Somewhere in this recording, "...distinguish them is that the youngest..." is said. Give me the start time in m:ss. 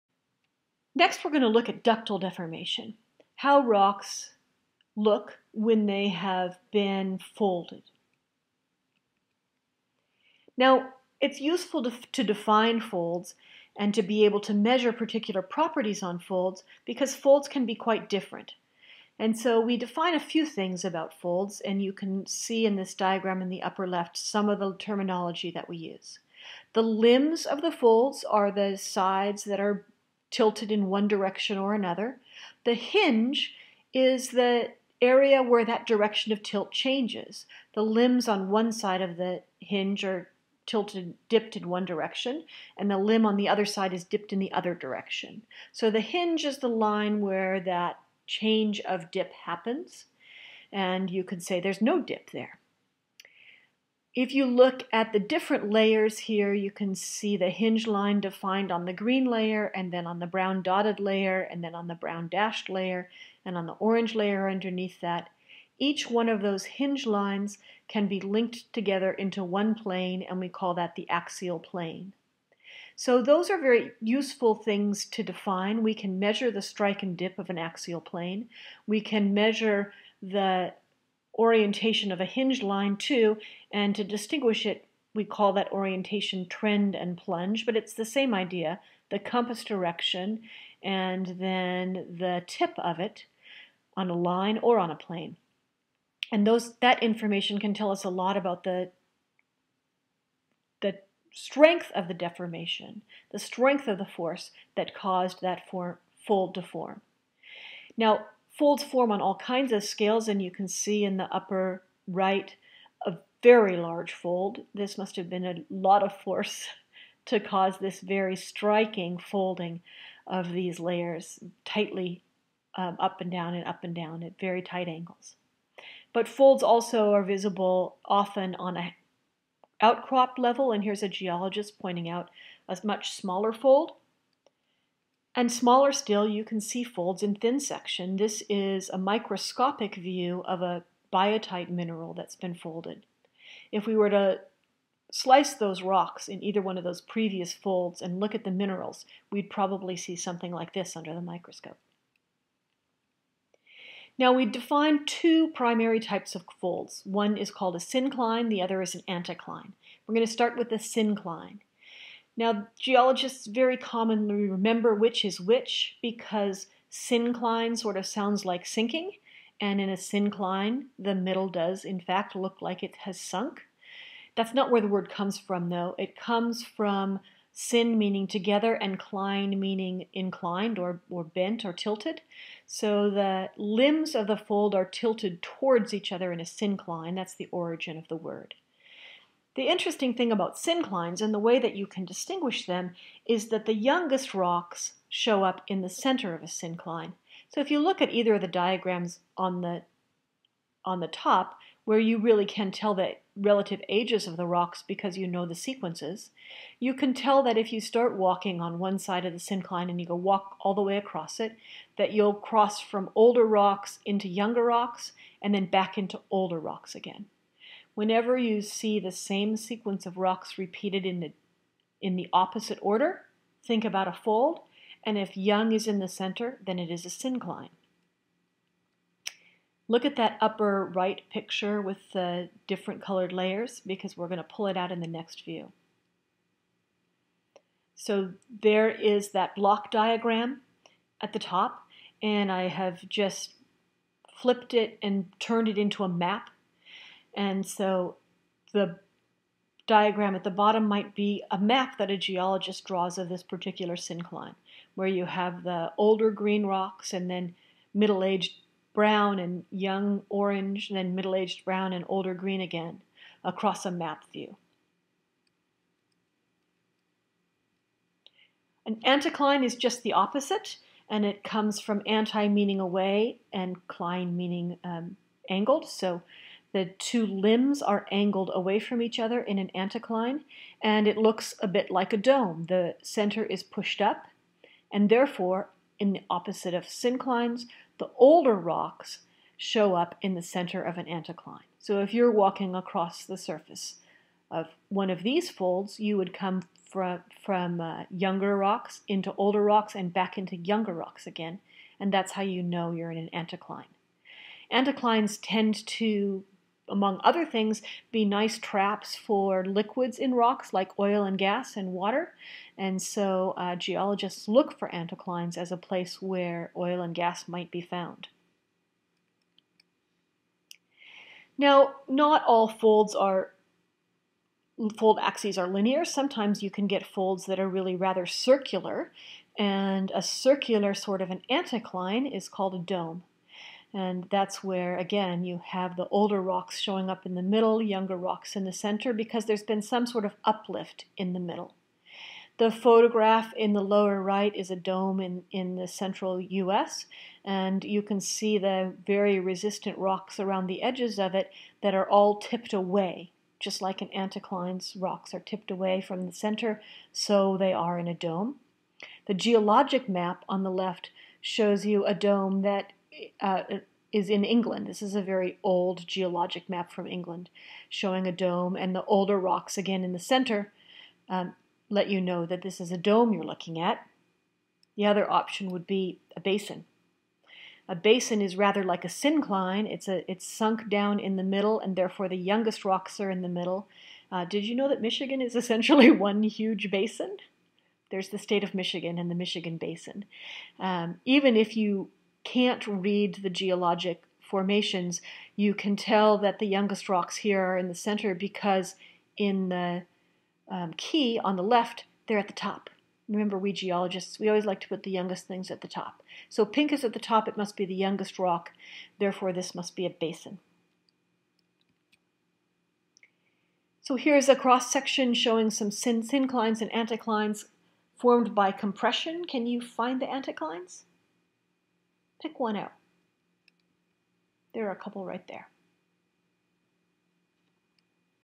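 3:12.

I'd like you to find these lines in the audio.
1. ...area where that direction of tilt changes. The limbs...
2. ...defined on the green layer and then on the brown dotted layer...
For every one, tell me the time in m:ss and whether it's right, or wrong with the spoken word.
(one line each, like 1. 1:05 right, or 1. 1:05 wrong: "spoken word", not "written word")
1. 0:35 right
2. 0:58 right.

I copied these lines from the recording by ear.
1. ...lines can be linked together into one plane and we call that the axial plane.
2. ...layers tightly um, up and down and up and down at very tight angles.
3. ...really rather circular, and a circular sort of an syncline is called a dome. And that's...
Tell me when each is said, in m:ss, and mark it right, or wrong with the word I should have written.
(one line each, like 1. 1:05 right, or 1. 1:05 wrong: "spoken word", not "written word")
1. 1:07 right
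2. 2:00 right
3. 5:27 wrong: "anticline", not "syncline".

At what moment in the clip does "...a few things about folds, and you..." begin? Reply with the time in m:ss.
0:20.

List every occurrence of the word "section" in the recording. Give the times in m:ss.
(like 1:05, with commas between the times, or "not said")
2:17, 6:54.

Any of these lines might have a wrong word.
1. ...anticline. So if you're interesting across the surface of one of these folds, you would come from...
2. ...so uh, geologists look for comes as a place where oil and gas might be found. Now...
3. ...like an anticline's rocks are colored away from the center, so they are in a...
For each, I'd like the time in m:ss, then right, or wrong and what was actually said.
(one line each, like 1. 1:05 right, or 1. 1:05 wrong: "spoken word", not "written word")
1. 4:51 wrong: "walking", not "interesting"
2. 5:13 wrong: "anticlines", not "comes"
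3. 5:53 wrong: "tipped", not "colored".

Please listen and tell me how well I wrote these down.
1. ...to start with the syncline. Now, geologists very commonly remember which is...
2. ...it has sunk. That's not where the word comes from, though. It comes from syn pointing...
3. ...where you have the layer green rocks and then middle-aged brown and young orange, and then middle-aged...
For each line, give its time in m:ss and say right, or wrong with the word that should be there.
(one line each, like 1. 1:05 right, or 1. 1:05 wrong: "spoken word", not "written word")
1. 2:40 right
2. 2:52 wrong: "meaning", not "pointing"
3. 4:14 wrong: "older", not "layer".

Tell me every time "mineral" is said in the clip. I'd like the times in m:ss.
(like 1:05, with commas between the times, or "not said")
2:21, 2:28.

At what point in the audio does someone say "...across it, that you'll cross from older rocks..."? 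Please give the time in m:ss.
3:30.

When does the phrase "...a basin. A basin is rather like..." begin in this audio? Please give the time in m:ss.
6:16.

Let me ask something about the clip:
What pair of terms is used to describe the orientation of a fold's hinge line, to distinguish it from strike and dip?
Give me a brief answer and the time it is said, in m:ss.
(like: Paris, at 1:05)
trend and plunge, at 1:26.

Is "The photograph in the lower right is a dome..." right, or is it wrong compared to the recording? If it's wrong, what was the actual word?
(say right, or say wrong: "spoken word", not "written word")
right.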